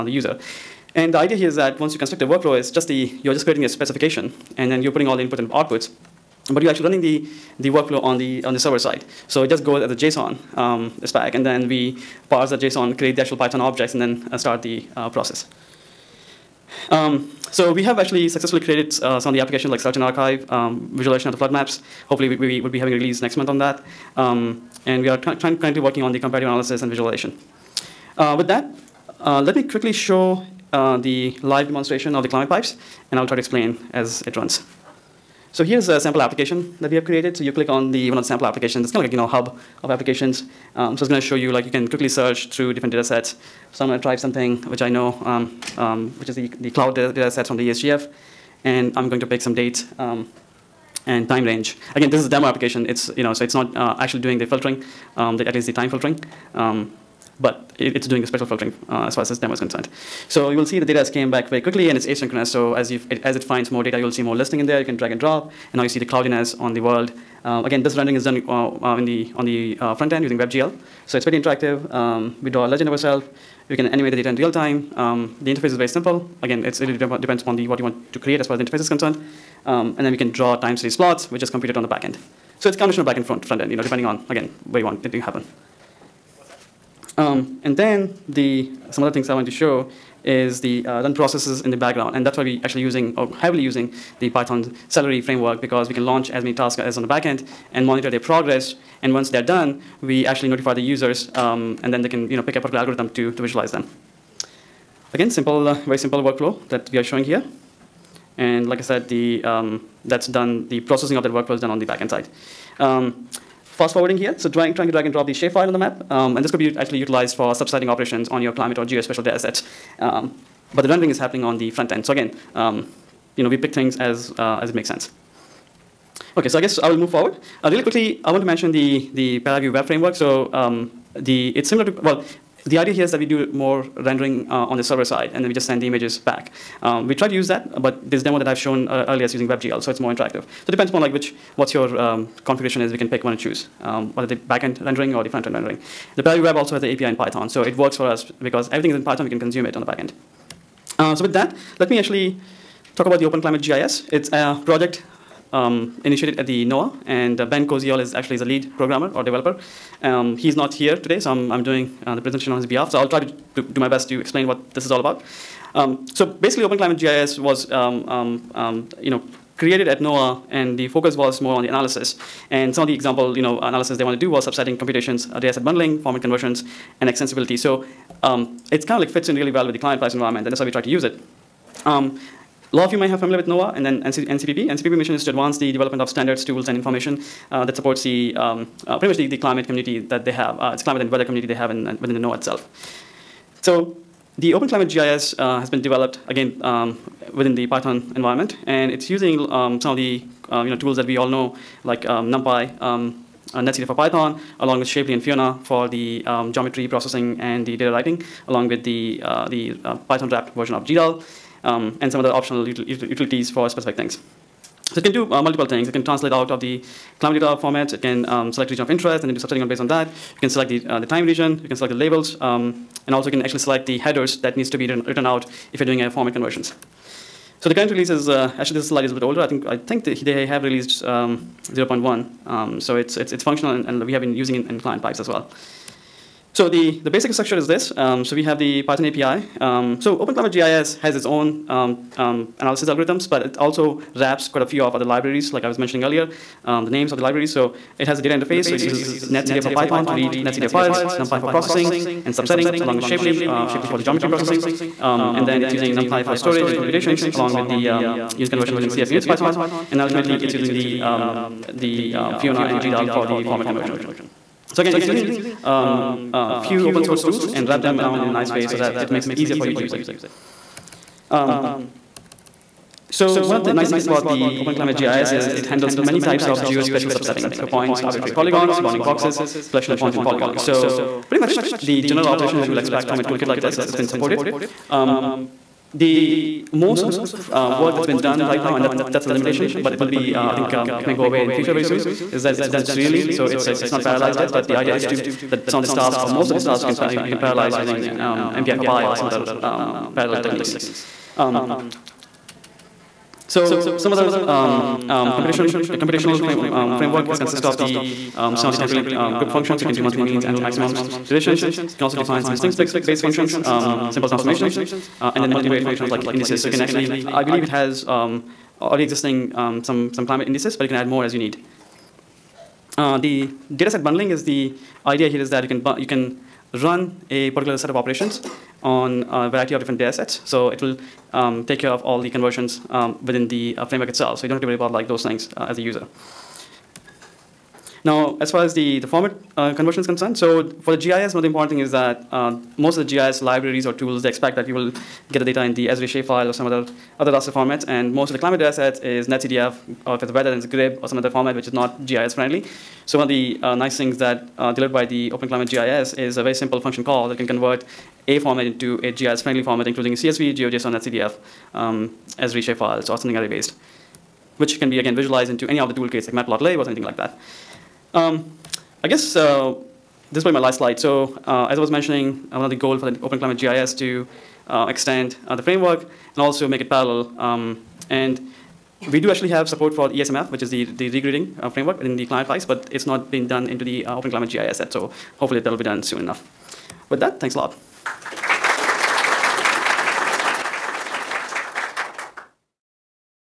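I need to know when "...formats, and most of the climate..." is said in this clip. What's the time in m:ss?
5:47.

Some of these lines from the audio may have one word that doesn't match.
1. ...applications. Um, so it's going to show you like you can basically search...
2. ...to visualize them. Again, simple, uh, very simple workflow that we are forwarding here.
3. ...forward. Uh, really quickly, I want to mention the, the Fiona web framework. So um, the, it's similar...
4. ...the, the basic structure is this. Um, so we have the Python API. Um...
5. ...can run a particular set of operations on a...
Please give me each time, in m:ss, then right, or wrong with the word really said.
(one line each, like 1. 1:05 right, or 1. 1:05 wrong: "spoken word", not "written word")
1. 0:39 wrong: "quickly", not "basically"
2. 1:43 wrong: "showing", not "forwarding"
3. 2:07 wrong: "Paraview", not "Fiona"
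4. 3:56 right
5. 5:26 right.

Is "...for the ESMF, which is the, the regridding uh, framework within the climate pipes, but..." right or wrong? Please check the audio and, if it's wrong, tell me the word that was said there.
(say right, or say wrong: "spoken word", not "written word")
right.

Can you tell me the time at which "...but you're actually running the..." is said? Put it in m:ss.
0:06.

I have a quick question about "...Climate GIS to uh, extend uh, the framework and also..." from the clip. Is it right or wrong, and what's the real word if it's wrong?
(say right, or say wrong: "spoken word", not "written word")
right.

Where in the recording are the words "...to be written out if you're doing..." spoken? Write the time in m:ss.
3:44.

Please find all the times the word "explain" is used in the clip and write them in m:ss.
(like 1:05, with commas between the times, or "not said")
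0:33, 2:44.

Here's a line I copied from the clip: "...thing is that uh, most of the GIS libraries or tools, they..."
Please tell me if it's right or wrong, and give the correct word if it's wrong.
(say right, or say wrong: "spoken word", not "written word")
right.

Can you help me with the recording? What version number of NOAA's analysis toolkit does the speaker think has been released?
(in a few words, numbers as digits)
0.1.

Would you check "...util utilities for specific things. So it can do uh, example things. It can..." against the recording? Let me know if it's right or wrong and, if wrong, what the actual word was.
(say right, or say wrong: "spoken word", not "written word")
wrong: "multiple", not "example".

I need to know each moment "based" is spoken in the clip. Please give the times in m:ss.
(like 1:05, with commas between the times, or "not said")
3:39, 5:12, 6:03.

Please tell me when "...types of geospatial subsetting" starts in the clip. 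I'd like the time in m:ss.
4:36.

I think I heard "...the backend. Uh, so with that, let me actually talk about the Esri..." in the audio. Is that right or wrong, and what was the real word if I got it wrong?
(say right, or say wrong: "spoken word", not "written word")
wrong: "Open", not "Esri".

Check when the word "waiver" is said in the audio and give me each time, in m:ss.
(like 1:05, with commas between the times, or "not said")
not said.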